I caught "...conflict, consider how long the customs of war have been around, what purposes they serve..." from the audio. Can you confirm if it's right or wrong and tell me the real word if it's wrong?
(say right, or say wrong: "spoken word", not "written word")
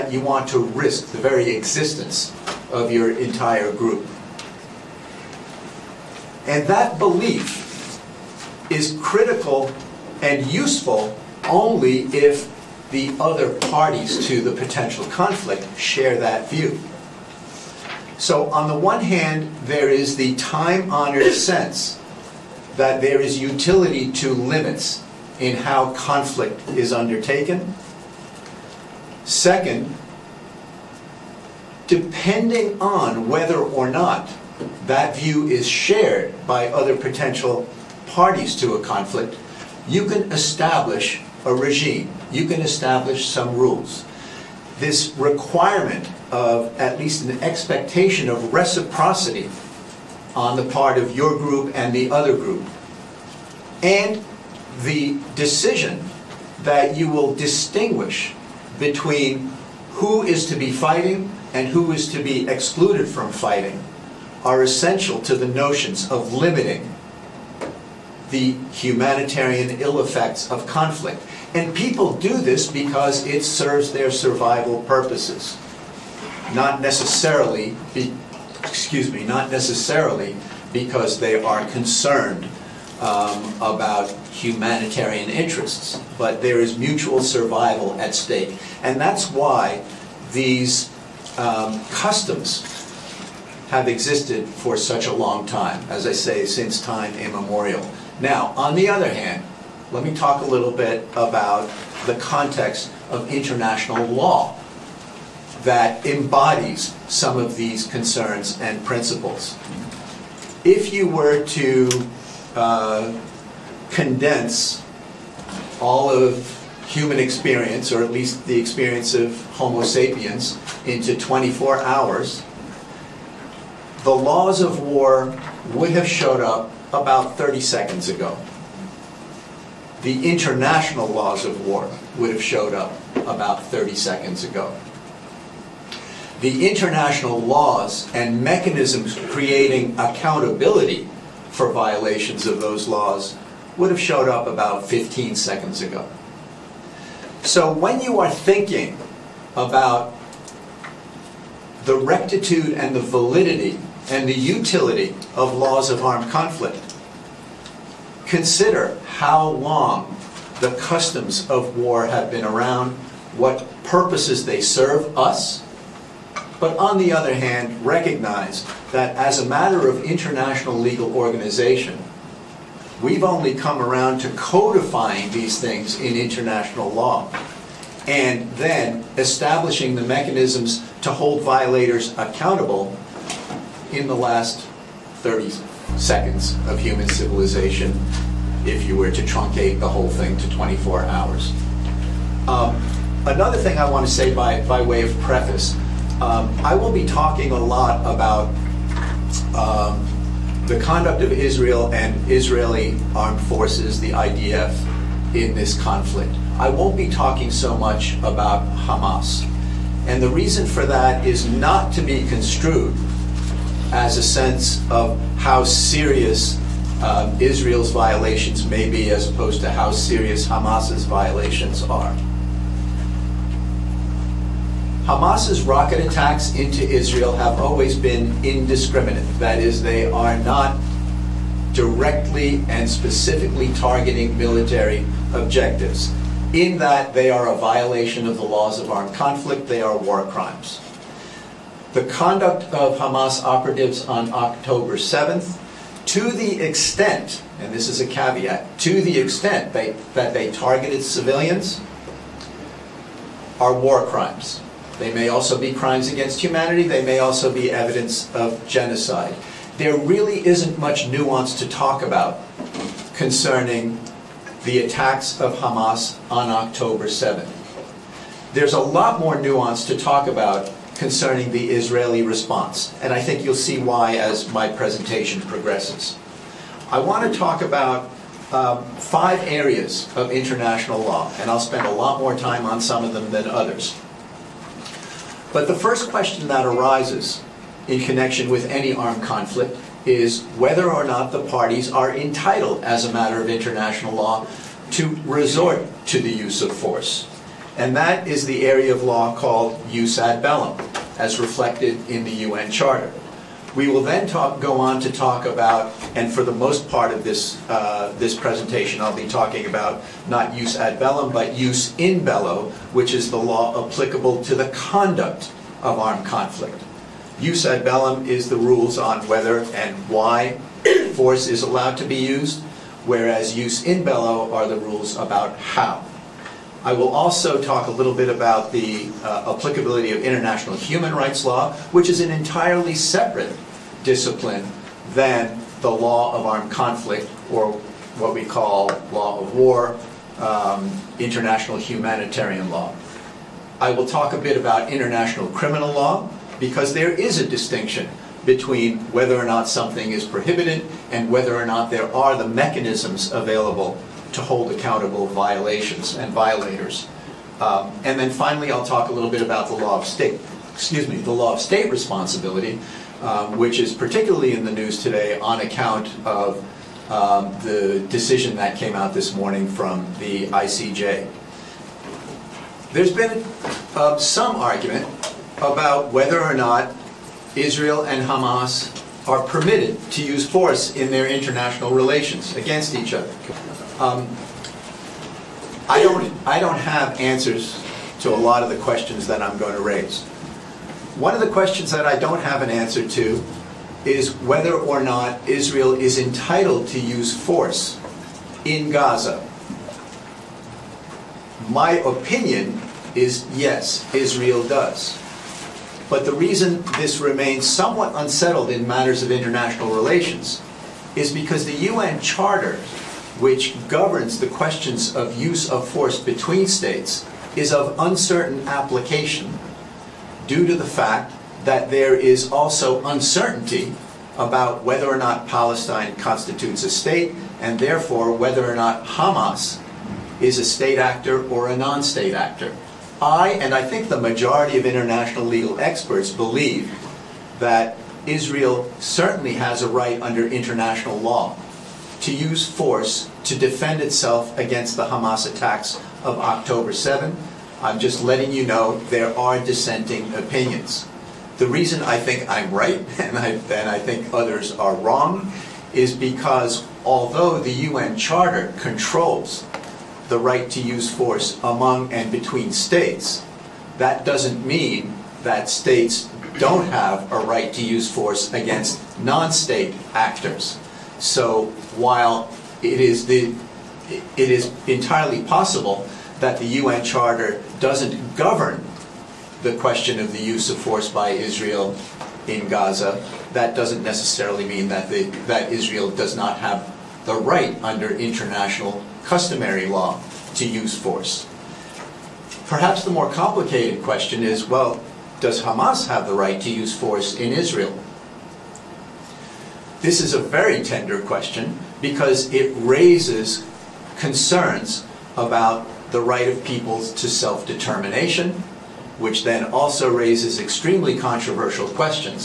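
right.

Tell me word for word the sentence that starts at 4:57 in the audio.
And that is the area of law called jus ad bellum, as reflected in the UN Charter.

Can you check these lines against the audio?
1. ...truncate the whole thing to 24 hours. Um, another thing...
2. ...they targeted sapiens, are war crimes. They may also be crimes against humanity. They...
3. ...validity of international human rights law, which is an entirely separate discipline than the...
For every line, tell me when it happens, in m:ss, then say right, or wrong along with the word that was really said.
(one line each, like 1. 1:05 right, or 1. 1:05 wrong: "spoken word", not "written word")
1. 3:09 right
2. 4:10 wrong: "civilians", not "sapiens"
3. 5:29 wrong: "applicability", not "validity".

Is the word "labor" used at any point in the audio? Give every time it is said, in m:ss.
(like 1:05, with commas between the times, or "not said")
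not said.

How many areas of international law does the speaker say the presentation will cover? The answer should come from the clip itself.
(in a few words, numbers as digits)
5.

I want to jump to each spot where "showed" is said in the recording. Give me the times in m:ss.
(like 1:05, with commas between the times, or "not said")
2:06, 2:12, 2:23.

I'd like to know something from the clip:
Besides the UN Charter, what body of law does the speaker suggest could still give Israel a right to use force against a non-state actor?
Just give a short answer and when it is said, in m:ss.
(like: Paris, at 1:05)
international customary law, at 8:08.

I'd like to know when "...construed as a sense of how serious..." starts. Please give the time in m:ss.
3:32.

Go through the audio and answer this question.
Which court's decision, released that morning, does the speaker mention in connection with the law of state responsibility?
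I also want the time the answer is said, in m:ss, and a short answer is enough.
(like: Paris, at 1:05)
ICJ, at 6:10.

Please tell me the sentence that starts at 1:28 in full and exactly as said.
And that's why these um, customs have existed for such a long time, as I say, since time immemorial.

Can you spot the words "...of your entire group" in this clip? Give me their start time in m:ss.
0:02.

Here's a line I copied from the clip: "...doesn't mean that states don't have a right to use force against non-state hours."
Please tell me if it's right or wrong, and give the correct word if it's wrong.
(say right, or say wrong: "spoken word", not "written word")
wrong: "actors", not "hours".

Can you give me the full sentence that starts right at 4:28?
There's a lot more nuance to talk about concerning the Israeli response, and I think you'll see why as my presentation progresses.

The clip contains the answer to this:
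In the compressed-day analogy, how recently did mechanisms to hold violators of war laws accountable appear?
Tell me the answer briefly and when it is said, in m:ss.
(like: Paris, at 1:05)
15 seconds ago, at 2:24.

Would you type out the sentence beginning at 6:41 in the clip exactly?
My opinion is yes, Israel does.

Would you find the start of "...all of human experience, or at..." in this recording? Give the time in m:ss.
1:55.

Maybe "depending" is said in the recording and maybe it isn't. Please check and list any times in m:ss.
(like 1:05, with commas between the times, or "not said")
0:31.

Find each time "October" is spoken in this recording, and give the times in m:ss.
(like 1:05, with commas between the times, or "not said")
4:04, 4:26, 7:26.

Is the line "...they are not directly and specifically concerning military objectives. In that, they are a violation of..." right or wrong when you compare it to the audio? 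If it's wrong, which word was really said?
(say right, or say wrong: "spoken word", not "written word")
wrong: "targeting", not "concerning".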